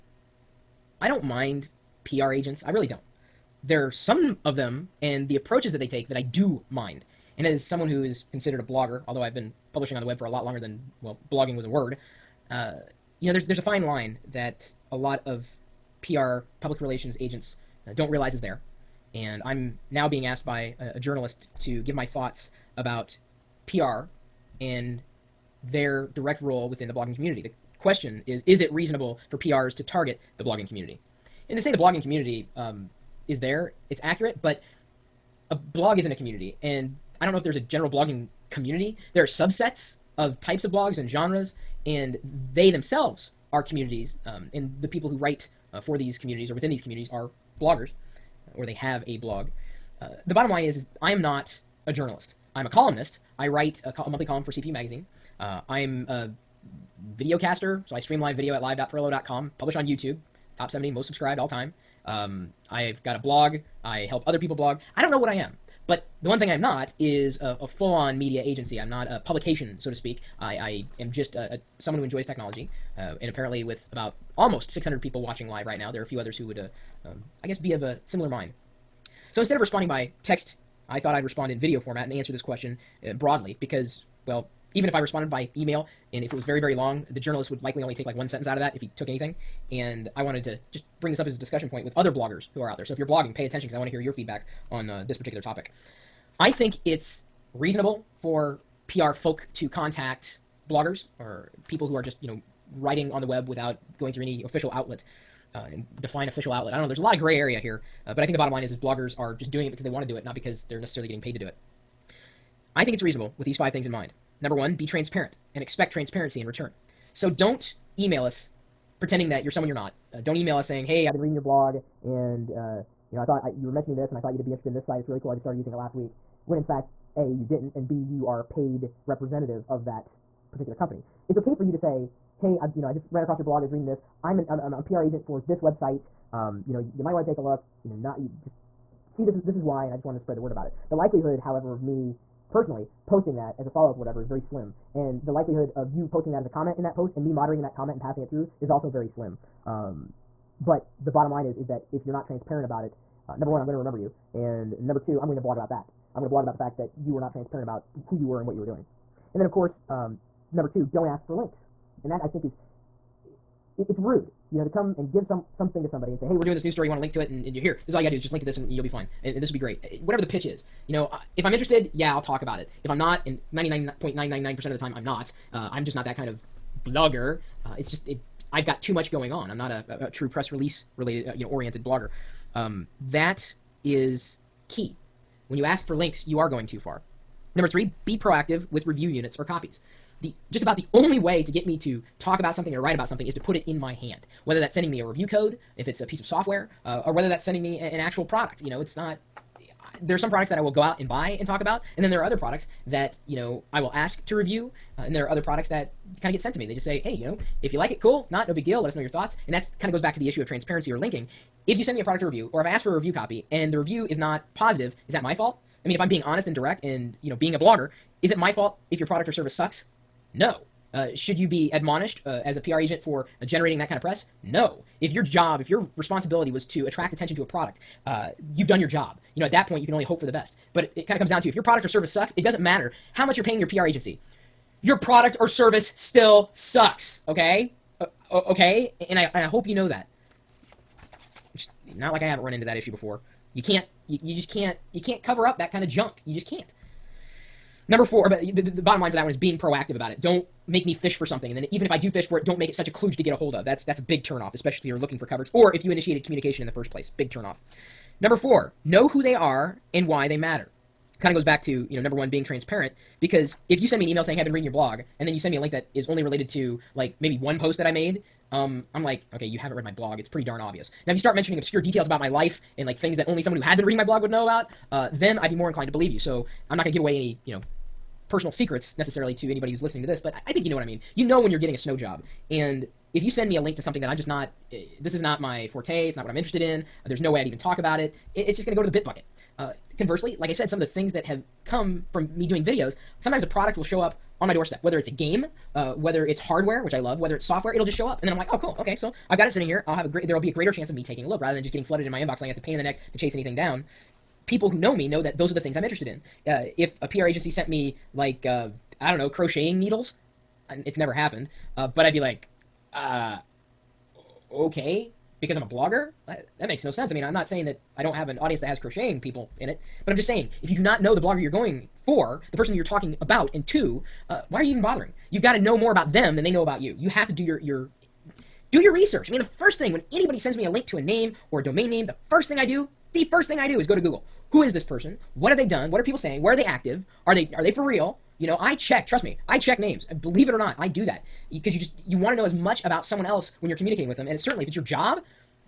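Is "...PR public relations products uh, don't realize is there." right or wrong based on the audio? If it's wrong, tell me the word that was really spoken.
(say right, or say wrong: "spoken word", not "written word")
wrong: "agents", not "products".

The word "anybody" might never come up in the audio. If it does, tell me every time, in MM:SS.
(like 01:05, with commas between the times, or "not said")
04:39, 05:30.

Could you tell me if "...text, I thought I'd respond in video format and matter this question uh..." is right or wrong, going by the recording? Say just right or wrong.
wrong.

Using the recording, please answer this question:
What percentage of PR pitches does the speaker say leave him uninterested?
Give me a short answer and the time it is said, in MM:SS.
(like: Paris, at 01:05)
99.999%, at 02:53.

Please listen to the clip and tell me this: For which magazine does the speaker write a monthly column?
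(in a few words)
CPU Magazine.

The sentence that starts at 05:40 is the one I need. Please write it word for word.
Believe it or not, I do that.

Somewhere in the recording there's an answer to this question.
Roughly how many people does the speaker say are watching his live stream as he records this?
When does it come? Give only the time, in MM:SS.
01:14.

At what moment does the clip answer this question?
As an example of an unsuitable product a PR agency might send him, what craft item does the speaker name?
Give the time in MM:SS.
05:09.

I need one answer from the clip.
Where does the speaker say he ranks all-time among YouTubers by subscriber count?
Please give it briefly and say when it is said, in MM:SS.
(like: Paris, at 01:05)
top 70, at 01:00.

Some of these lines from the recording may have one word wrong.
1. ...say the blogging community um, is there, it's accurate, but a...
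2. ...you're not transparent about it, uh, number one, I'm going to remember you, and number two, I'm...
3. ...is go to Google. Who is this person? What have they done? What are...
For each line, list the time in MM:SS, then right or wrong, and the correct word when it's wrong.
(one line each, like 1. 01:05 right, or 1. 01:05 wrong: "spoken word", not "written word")
1. 00:31 right
2. 02:32 right
3. 05:33 right.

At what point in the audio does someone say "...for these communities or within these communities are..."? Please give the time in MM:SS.
00:45.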